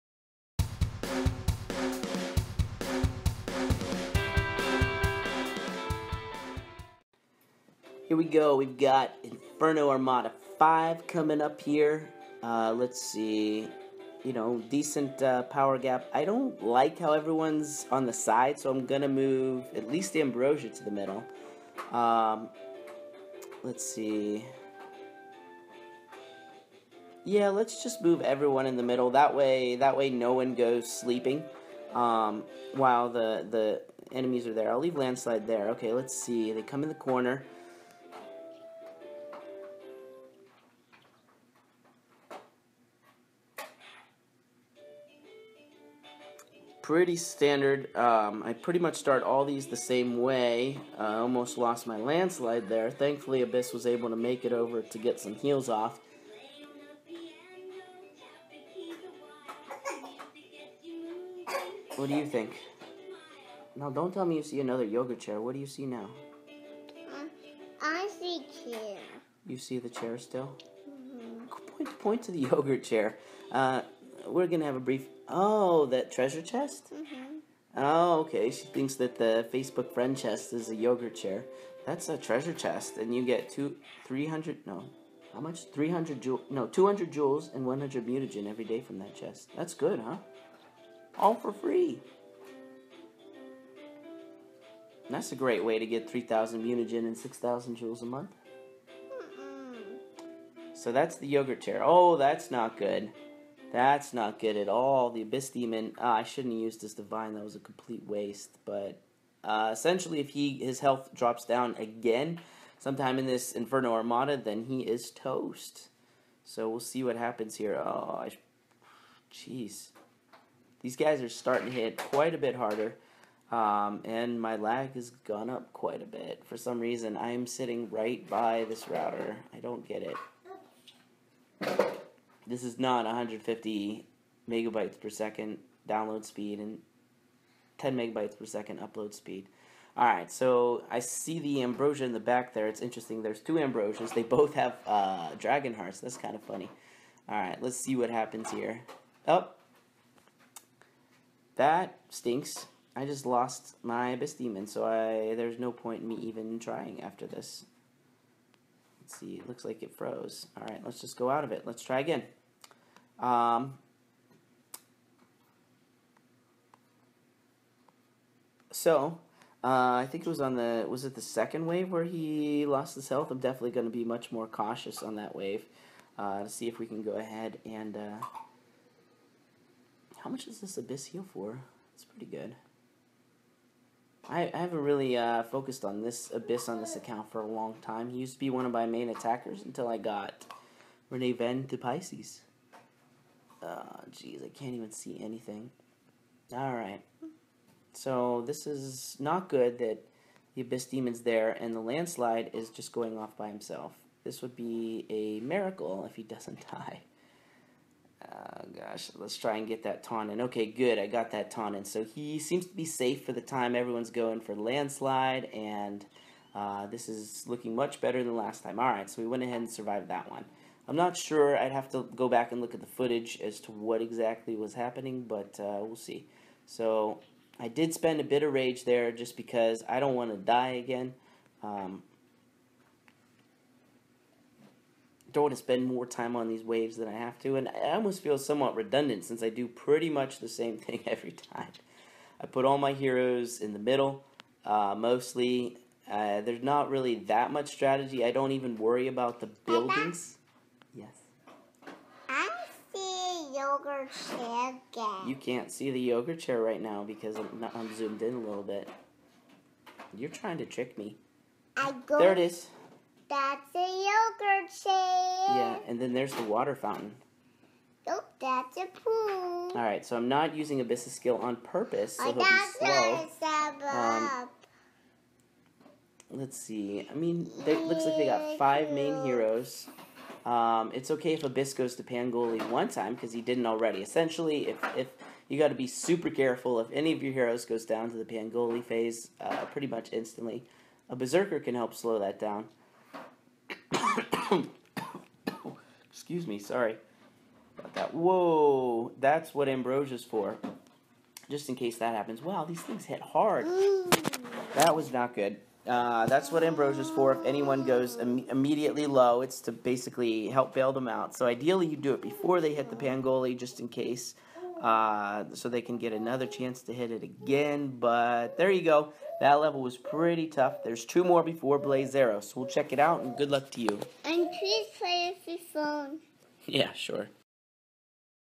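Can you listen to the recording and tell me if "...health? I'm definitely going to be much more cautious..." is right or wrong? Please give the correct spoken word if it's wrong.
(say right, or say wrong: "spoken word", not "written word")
right.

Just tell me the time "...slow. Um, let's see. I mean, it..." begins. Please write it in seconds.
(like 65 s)
273 s.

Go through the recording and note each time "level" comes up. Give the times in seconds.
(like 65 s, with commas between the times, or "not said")
319 s.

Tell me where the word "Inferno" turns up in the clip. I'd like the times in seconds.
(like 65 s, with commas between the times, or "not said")
9 s, 113 s.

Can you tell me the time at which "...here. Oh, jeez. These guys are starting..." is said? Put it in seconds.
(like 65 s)
117 s.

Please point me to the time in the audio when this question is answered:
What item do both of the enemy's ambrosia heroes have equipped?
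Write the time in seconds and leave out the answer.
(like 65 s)
145 s.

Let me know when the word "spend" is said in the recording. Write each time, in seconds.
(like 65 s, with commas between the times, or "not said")
227 s, 235 s.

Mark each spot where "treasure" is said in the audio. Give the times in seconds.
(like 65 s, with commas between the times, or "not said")
76 s, 82 s.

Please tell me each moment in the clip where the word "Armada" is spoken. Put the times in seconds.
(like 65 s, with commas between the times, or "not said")
9 s, 113 s.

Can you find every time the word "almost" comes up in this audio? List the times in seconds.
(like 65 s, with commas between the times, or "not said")
51 s, 237 s.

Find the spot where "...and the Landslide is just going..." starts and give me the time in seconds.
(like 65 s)
201 s.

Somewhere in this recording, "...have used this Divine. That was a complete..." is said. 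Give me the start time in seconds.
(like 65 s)
106 s.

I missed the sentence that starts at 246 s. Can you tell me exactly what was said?
Uh, there's not really that much strategy.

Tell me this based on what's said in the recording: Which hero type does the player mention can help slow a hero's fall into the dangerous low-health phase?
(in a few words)
Berserker.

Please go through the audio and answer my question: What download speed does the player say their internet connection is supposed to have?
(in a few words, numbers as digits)
150 megabytes per second.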